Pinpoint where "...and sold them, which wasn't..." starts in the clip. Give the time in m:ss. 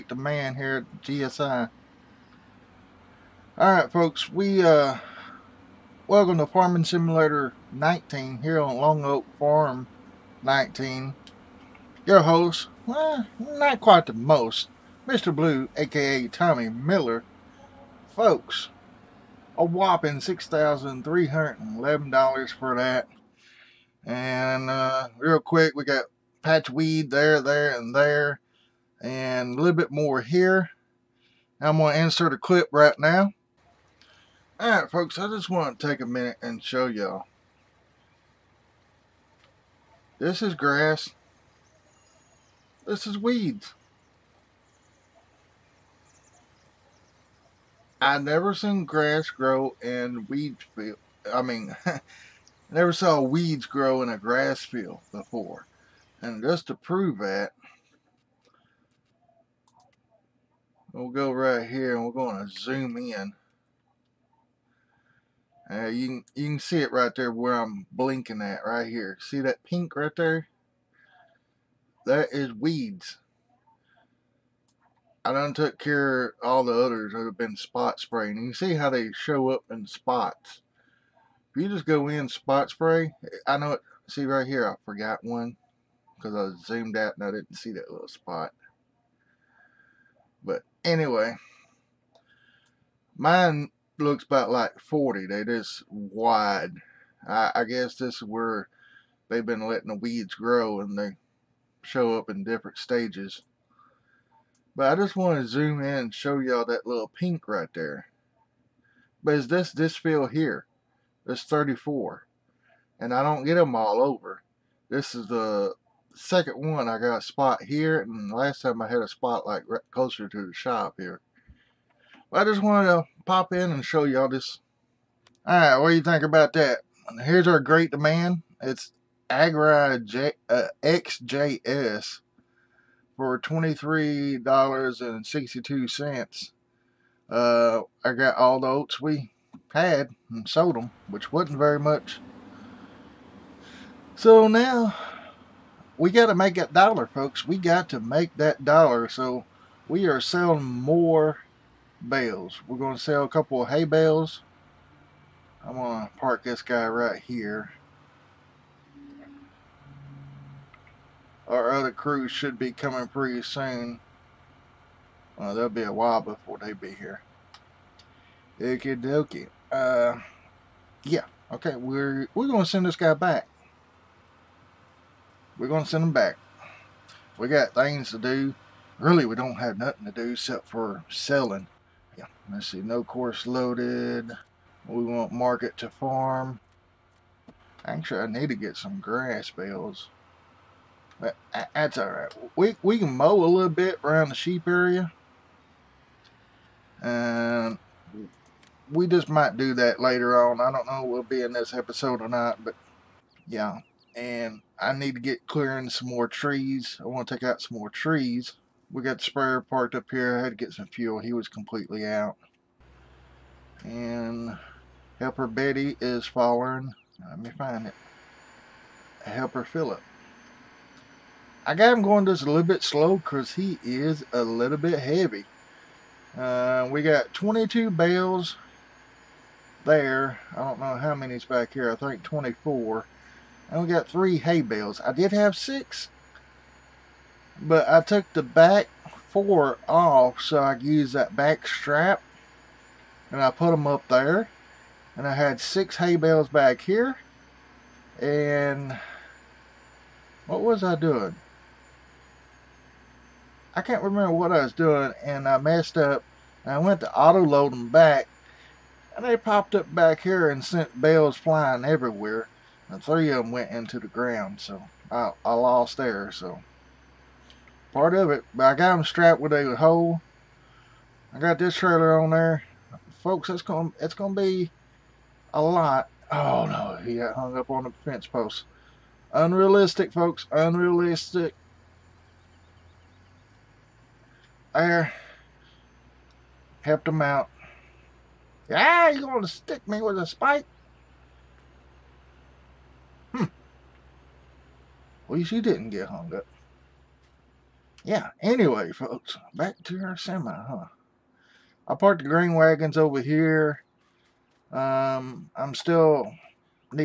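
2:20.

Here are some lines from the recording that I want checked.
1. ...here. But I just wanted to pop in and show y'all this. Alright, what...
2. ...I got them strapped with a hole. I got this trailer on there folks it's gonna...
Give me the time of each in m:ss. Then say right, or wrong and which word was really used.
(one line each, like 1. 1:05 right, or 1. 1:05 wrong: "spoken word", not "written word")
1. 2:00 right
2. 4:28 right.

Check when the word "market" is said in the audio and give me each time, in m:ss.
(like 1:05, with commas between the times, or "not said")
3:05.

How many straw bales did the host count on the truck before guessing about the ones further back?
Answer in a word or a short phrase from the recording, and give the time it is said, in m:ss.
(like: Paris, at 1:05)
22, at 3:47.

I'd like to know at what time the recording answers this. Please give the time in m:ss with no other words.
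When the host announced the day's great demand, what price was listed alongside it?
2:13.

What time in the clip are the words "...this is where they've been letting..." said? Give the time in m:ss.
1:37.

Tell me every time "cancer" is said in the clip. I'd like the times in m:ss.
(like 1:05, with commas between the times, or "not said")
not said.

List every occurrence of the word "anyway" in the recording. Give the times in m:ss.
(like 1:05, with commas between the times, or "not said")
1:30, 4:58.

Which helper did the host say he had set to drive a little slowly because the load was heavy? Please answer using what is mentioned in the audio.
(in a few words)
Philip.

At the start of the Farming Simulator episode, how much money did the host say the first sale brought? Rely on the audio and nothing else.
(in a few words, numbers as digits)
$6,311.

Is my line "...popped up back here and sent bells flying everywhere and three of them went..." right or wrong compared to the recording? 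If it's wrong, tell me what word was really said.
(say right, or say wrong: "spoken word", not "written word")
right.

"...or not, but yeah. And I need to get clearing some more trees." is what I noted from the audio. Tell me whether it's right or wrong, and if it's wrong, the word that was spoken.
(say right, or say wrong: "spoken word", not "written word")
right.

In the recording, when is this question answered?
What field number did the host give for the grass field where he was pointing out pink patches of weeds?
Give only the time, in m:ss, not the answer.
1:51.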